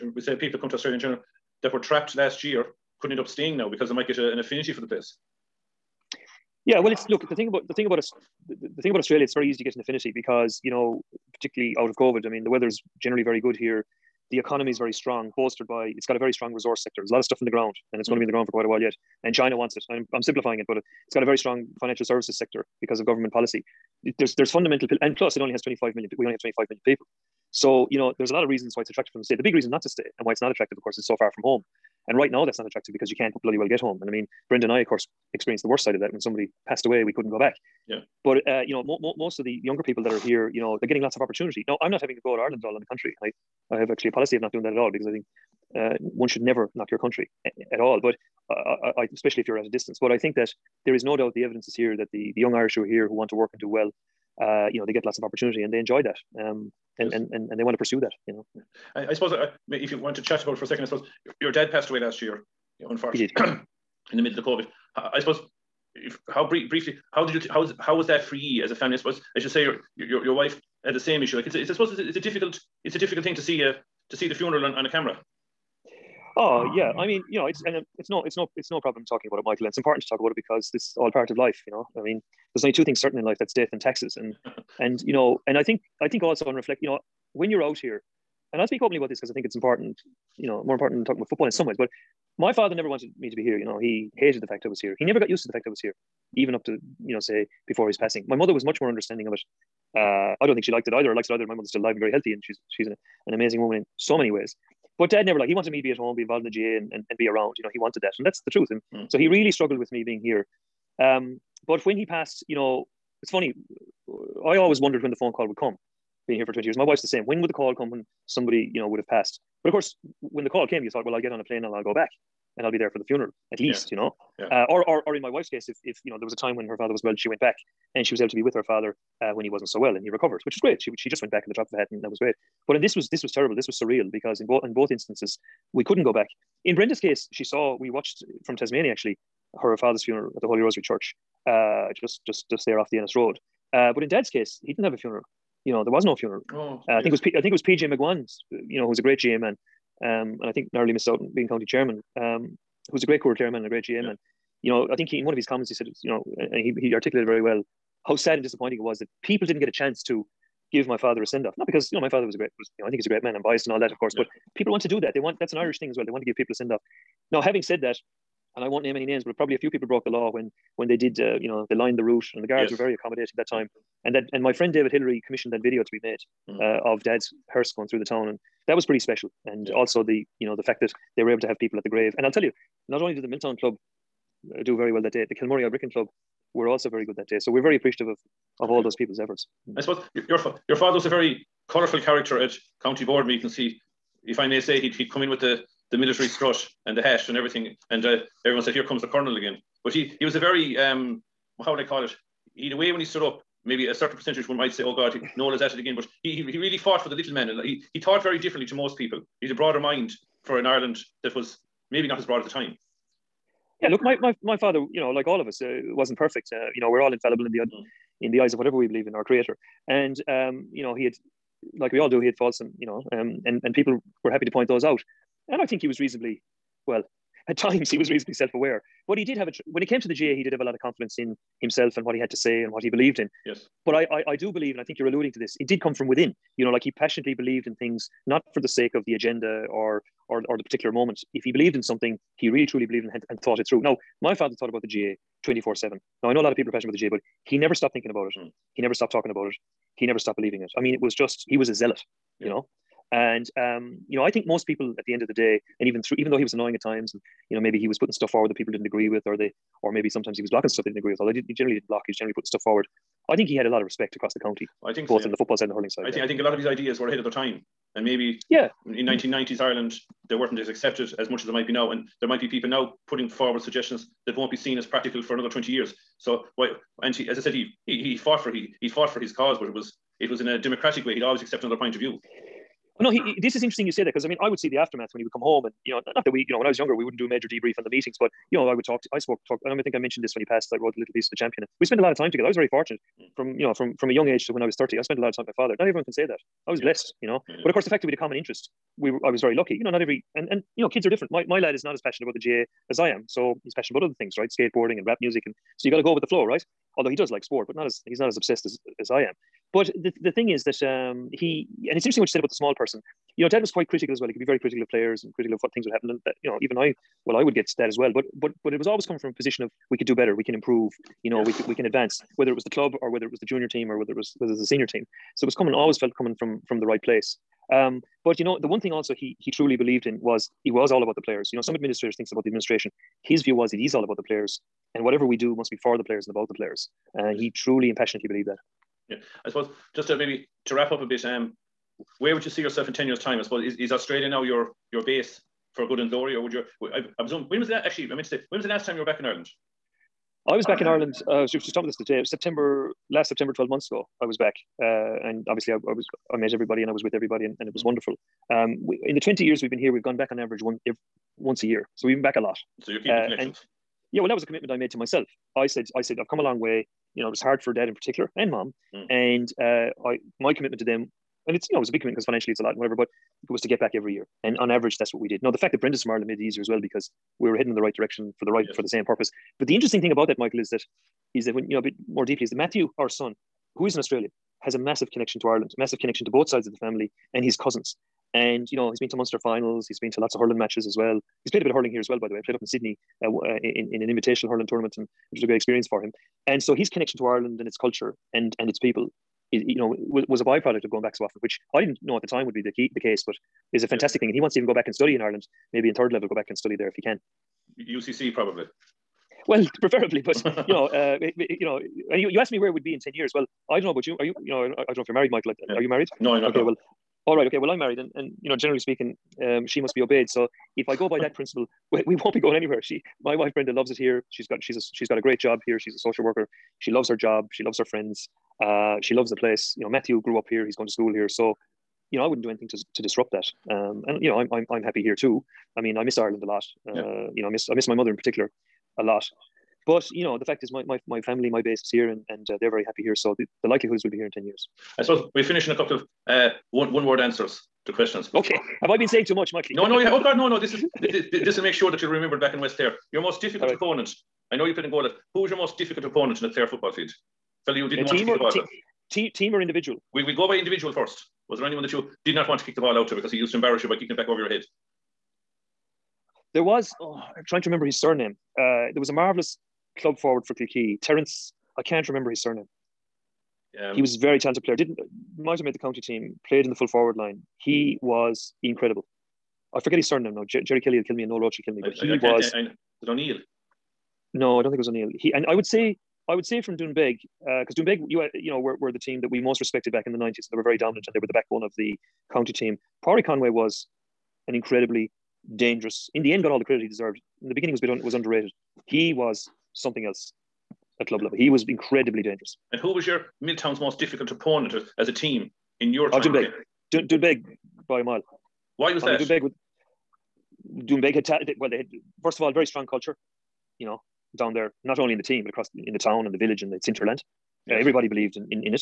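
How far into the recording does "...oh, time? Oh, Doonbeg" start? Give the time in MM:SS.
08:26.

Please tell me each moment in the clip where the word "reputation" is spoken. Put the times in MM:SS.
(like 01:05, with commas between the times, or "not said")
not said.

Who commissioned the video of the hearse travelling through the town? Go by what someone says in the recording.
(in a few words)
David Hillary.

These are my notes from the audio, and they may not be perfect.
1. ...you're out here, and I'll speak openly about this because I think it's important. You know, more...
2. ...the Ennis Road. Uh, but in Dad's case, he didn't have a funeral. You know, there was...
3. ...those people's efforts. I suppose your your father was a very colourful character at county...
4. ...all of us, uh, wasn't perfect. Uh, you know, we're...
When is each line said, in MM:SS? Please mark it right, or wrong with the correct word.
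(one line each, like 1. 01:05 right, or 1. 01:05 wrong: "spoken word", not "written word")
1. 01:27 right
2. 02:22 right
3. 03:08 right
4. 03:35 right.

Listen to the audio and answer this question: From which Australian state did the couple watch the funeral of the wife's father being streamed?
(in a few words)
Tasmania.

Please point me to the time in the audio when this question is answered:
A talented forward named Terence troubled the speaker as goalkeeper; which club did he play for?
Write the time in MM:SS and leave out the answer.
07:50.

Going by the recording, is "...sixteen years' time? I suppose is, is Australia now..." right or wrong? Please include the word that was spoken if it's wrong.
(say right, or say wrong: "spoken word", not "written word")
wrong: "ten", not "sixteen".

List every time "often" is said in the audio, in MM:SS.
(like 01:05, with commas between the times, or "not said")
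06:41.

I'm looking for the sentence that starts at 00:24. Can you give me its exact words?
There's there's fundamental and plus it only has 25 million.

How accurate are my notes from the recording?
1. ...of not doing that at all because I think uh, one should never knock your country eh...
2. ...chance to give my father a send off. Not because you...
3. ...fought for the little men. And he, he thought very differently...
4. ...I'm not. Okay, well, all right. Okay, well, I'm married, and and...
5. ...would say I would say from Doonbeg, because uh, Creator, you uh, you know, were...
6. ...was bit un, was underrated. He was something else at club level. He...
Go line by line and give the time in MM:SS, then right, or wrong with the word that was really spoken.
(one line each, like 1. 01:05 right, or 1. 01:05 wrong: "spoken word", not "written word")
1. 00:44 right
2. 02:39 right
3. 03:26 right
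4. 06:56 right
5. 08:05 wrong: "Doonbeg", not "Creator"
6. 08:17 right.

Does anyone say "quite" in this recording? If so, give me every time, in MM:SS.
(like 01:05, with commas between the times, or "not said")
00:18, 05:13.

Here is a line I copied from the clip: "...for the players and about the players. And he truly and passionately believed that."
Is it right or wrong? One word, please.
right.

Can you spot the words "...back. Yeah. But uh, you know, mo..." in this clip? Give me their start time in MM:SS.
00:37.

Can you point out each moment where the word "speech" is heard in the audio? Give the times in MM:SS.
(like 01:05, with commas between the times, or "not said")
not said.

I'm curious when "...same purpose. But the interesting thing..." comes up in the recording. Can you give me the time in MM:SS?
06:18.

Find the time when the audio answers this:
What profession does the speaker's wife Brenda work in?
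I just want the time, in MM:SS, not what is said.
07:05.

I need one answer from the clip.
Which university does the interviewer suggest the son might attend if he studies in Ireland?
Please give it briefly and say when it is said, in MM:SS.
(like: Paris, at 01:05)
UCC, at 06:47.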